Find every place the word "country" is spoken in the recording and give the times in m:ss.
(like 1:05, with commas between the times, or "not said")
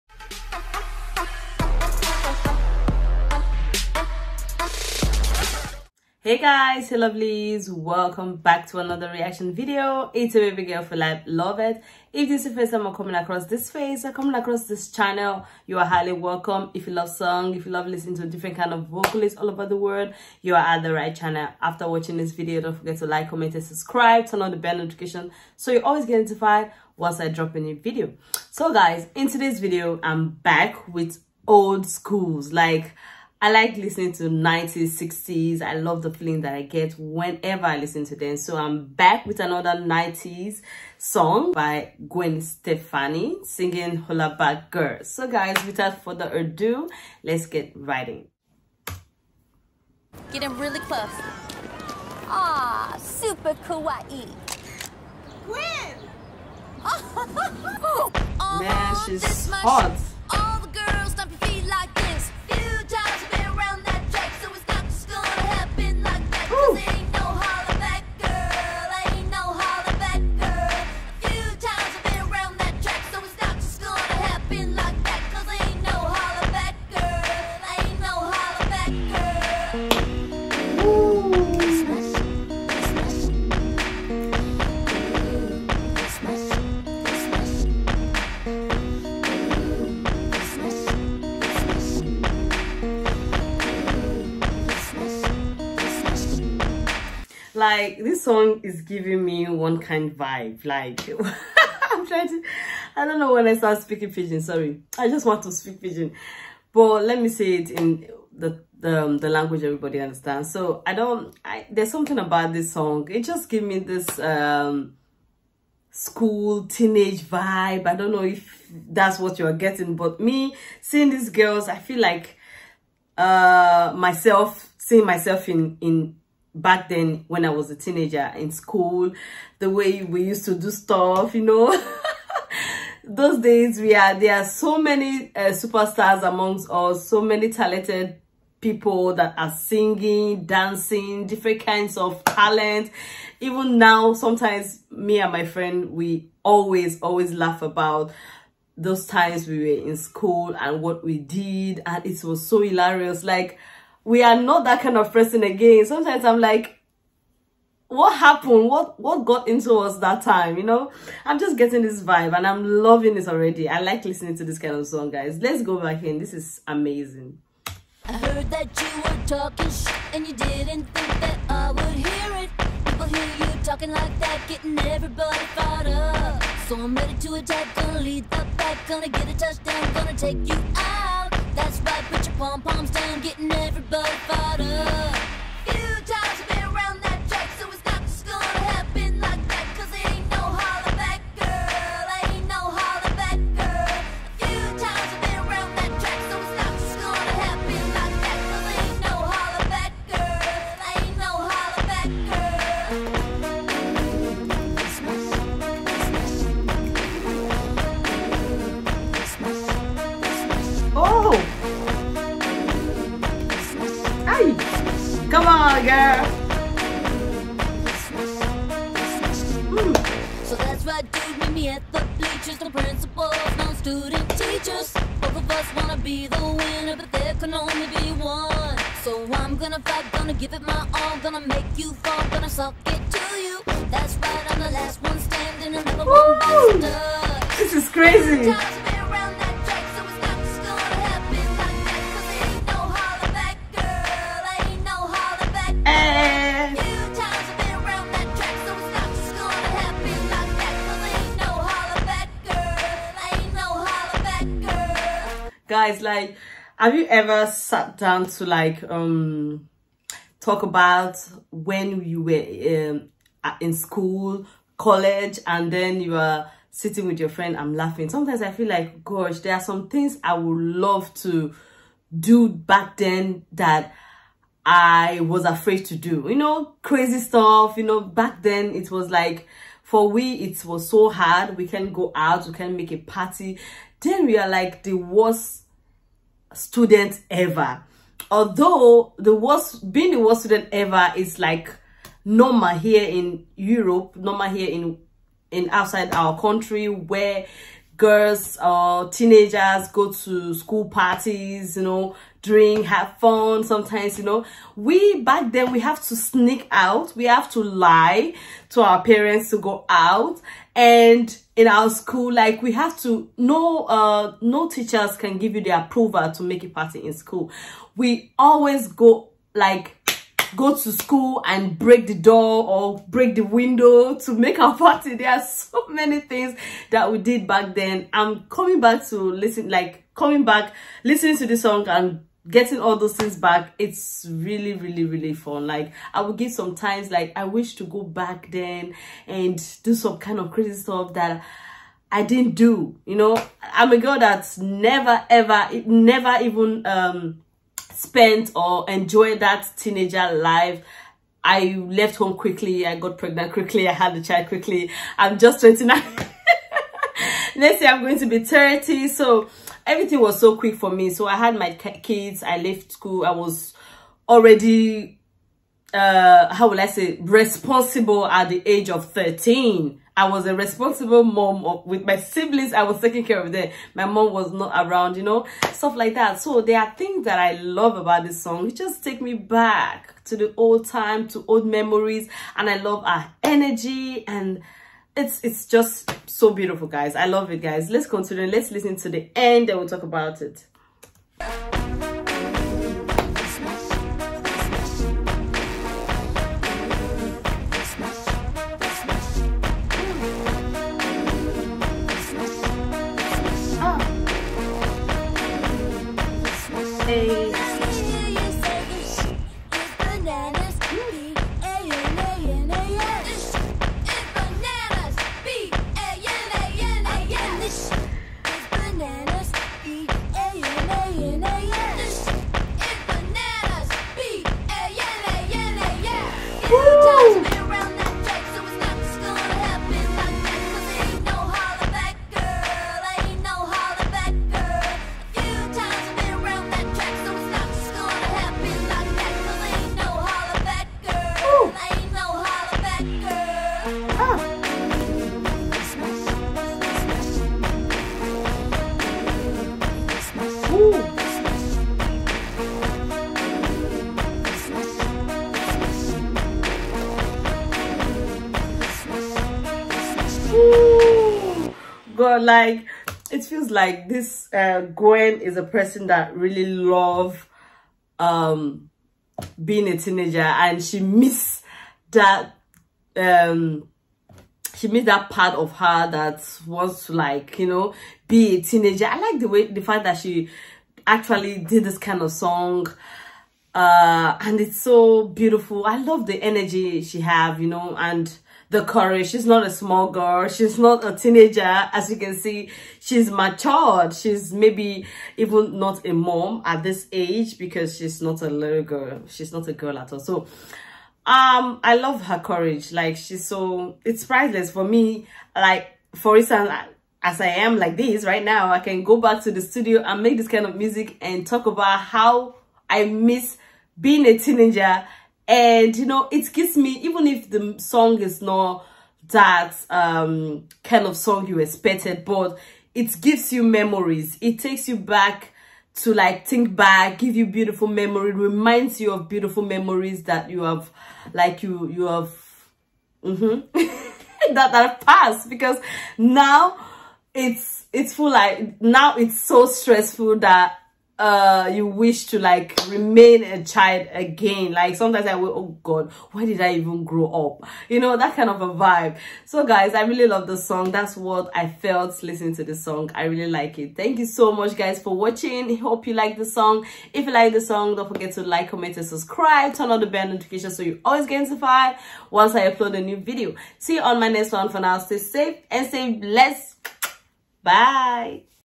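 4:56.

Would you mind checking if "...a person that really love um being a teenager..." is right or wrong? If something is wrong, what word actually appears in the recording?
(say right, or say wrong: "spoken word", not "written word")
right.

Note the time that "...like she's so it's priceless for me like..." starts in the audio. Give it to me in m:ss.
8:22.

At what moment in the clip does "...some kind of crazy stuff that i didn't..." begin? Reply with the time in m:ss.
5:39.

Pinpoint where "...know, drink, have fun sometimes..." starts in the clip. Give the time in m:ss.
5:01.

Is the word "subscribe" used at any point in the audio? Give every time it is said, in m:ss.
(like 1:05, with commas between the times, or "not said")
0:23, 9:19.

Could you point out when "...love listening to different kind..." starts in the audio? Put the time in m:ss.
0:17.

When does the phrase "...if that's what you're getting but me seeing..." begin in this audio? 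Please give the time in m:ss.
1:58.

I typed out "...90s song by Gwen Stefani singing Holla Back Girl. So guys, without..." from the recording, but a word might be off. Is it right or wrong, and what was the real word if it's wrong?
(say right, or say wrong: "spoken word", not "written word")
right.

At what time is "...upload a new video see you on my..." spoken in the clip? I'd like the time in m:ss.
9:22.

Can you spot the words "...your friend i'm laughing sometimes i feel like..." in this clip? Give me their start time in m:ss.
4:27.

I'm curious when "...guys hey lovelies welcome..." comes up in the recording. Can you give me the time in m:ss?
0:06.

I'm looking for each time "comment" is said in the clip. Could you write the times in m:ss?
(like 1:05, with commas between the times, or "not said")
0:23, 9:18.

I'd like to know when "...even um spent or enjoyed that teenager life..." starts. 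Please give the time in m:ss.
5:46.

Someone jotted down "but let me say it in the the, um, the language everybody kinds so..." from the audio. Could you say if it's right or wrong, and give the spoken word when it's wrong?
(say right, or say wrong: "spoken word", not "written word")
wrong: "understands", not "kinds".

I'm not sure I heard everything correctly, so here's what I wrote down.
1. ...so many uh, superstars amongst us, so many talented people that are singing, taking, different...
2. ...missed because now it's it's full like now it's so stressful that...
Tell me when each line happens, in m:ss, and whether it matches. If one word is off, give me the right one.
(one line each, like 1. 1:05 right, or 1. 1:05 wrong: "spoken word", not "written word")
1. 2:14 wrong: "dancing", not "taking"
2. 8:55 wrong: "passed", not "missed".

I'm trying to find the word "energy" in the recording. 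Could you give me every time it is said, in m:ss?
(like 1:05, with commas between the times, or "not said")
6:23, 8:06.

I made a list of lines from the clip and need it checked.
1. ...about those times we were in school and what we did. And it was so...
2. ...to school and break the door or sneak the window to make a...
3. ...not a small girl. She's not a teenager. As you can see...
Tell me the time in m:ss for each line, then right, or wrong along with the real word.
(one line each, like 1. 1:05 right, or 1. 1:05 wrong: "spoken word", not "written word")
1. 2:27 right
2. 5:20 wrong: "break", not "sneak"
3. 8:09 right.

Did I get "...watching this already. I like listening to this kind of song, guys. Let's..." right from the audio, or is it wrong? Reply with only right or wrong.
wrong.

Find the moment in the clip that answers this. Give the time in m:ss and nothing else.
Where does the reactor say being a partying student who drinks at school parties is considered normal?
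4:53.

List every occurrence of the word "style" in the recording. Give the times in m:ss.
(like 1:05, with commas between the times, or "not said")
not said.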